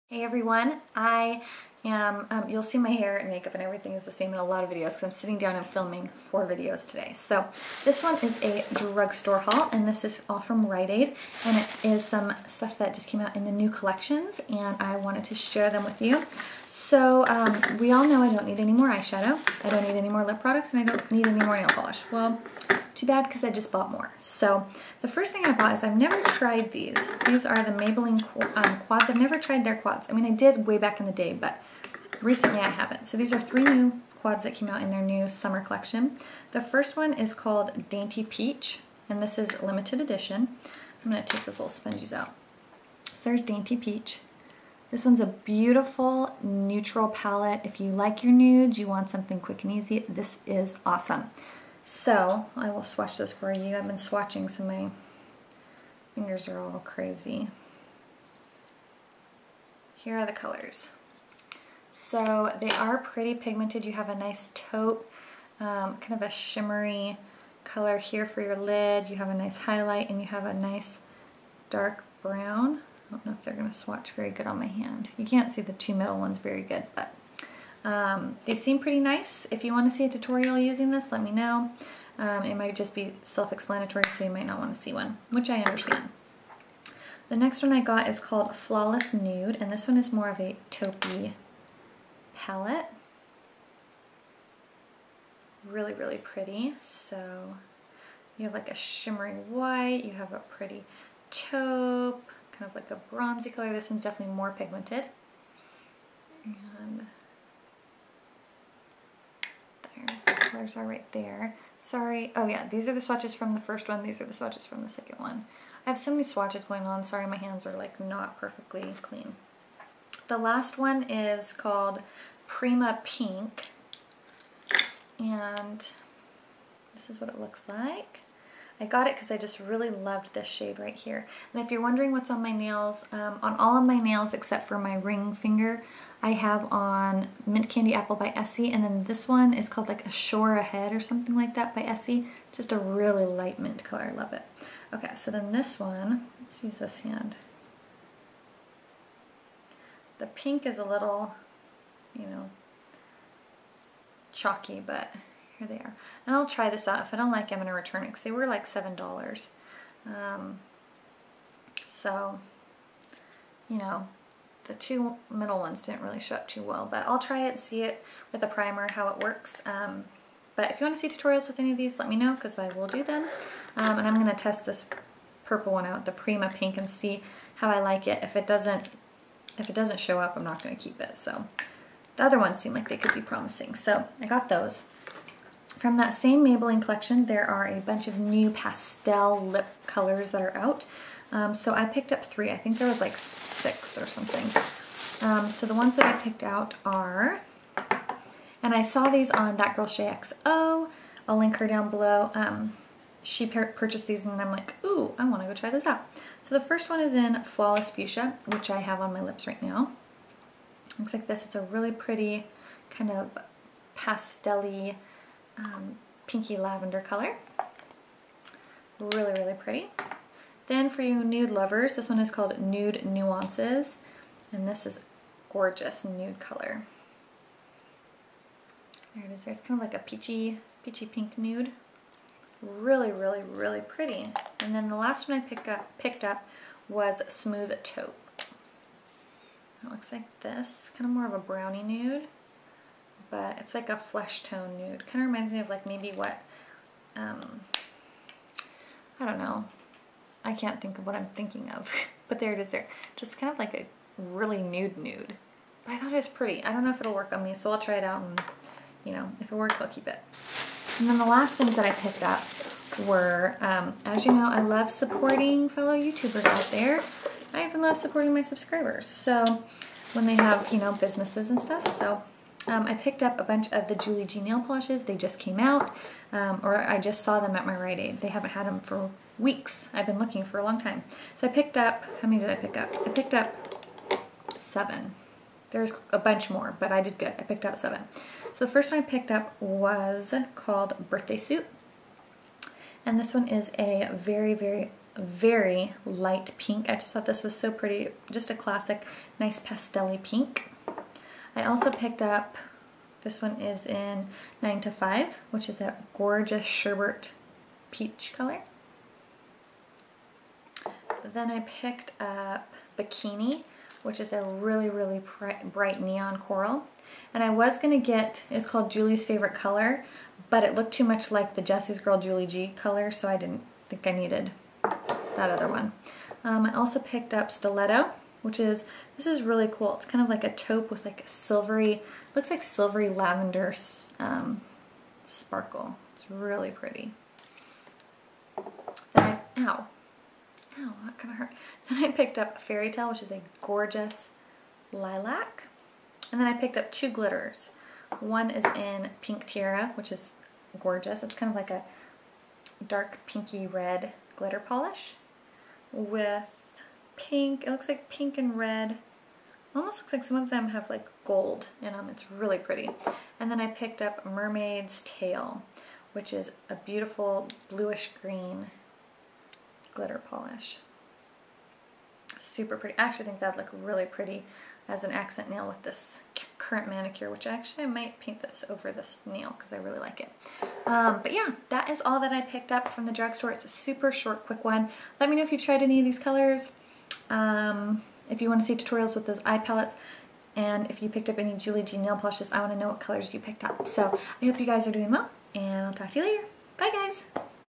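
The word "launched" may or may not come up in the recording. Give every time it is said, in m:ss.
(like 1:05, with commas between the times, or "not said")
not said.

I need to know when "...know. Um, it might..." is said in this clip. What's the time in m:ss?
1:21.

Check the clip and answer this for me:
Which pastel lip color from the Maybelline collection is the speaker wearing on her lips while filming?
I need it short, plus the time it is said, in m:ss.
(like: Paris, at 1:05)
Flawless Fuchsia, at 3:27.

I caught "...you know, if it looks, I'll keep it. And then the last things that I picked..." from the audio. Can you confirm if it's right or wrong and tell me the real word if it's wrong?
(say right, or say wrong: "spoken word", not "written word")
wrong: "works", not "looks".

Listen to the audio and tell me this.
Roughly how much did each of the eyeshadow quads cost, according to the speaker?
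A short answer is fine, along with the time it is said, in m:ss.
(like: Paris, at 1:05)
$7, at 2:38.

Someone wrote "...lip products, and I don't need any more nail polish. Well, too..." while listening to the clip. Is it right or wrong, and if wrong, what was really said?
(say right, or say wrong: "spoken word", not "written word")
right.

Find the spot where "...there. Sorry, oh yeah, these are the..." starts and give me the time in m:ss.
1:51.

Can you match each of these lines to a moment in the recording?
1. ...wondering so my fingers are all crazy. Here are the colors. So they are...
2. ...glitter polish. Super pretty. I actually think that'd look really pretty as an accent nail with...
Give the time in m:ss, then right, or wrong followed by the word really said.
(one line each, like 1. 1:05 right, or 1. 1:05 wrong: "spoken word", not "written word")
1. 0:53 wrong: "swatching", not "wondering"
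2. 6:09 right.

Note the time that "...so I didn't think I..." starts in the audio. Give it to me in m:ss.
5:23.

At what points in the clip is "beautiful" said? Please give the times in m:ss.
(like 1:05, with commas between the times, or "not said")
0:45, 6:06.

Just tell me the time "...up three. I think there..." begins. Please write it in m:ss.
3:12.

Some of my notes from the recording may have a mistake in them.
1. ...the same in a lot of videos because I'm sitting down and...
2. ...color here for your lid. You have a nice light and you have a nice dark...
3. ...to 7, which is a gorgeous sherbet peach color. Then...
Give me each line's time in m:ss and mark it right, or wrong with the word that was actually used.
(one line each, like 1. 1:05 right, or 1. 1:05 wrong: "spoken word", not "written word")
1. 0:04 right
2. 1:07 wrong: "highlight", not "light"
3. 5:04 wrong: "5", not "7".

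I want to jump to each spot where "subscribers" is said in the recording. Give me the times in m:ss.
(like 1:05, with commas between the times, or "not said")
4:28.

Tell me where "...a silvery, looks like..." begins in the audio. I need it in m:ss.
5:31.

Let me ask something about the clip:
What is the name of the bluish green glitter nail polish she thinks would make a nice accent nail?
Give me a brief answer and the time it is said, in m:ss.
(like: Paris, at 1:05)
Mermaid's Tail, at 6:04.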